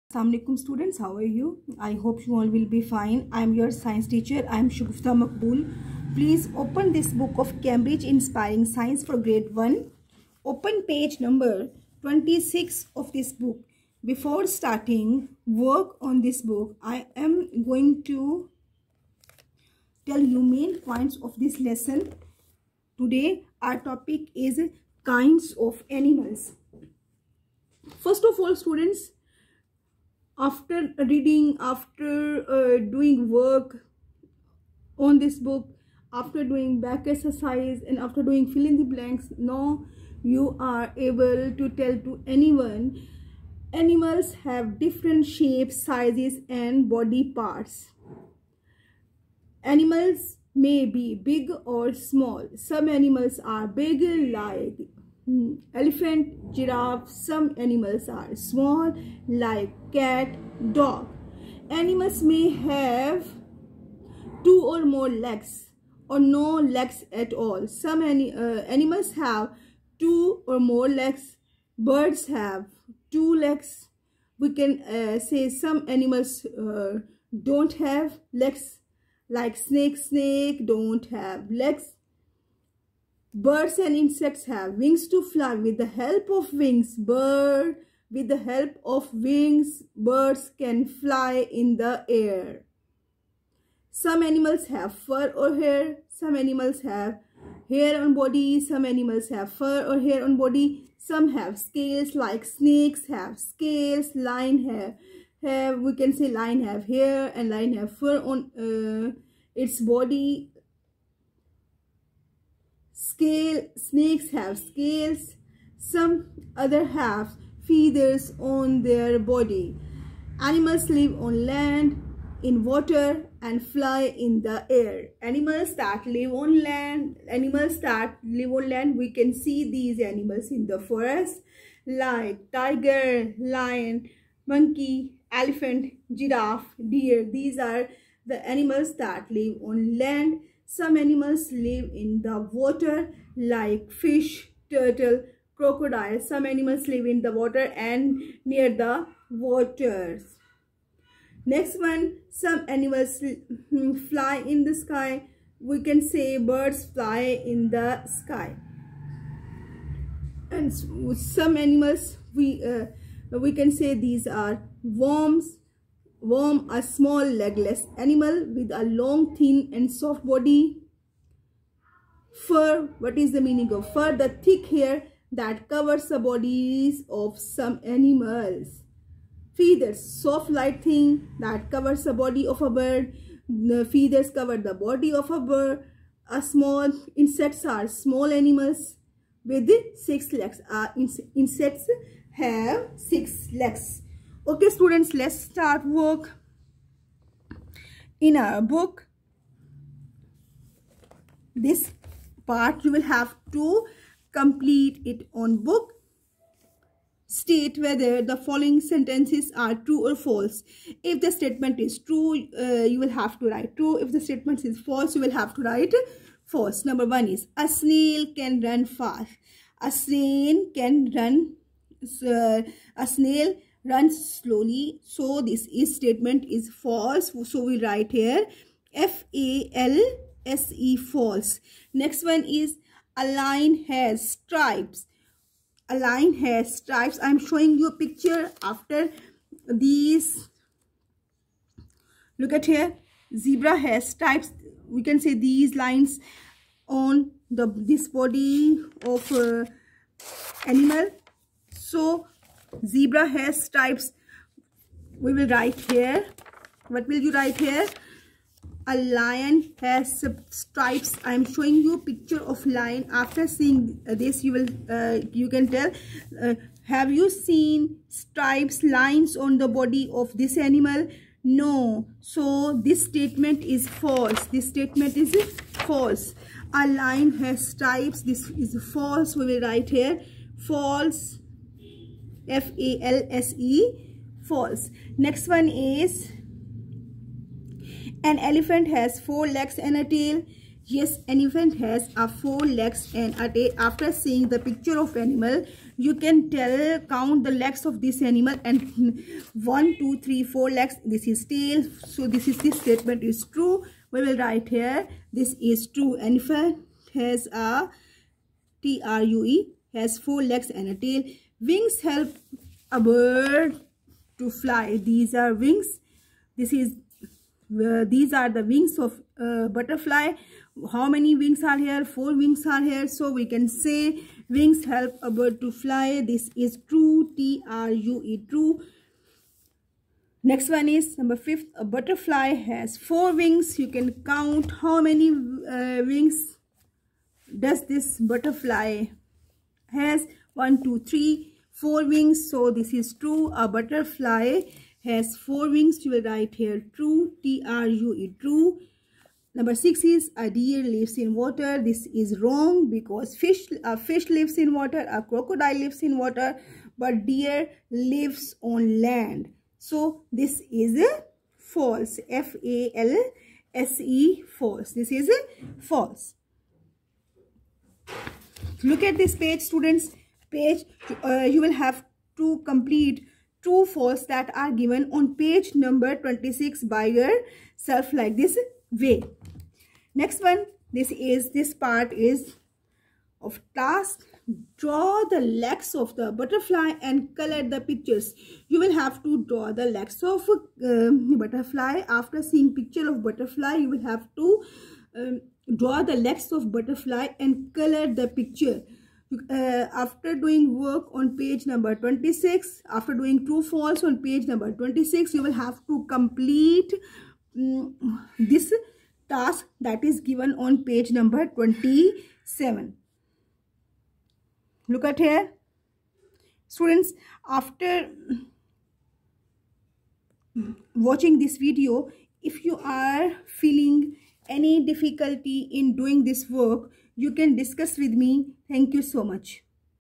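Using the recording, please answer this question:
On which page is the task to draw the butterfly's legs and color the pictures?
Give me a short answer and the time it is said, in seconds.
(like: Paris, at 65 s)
27, at 411 s.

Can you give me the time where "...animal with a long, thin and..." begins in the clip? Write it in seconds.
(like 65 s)
167 s.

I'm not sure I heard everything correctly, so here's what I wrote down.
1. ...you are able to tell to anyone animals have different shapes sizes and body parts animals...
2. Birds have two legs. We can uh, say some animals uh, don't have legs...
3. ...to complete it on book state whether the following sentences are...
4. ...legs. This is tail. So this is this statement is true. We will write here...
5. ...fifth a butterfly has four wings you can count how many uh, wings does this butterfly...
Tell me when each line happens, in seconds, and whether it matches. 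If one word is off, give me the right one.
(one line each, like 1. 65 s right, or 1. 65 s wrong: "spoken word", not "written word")
1. 40 s right
2. 71 s right
3. 203 s right
4. 300 s right
5. 331 s right.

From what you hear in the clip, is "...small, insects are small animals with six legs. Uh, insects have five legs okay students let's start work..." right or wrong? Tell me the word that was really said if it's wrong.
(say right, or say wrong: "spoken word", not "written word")
wrong: "six", not "five".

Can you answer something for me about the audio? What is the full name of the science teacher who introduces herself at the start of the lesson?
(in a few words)
Shagufta Maqbool.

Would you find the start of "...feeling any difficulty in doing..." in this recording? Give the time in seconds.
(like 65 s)
423 s.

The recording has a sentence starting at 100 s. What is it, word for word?
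Some have scales like snakes have scales.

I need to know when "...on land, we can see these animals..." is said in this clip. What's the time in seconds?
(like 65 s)
128 s.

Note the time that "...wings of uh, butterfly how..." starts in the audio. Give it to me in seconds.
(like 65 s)
318 s.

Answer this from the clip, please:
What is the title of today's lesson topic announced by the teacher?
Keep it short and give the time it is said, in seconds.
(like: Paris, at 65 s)
Kinds of animals, at 25 s.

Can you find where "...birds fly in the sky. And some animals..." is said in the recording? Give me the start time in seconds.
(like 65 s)
156 s.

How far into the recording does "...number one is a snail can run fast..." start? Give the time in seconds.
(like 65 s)
216 s.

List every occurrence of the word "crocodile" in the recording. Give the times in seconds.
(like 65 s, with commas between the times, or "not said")
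145 s, 355 s.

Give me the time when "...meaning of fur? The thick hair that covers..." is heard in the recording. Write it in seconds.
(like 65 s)
173 s.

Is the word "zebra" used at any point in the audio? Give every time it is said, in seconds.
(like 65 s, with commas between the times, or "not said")
243 s, 252 s.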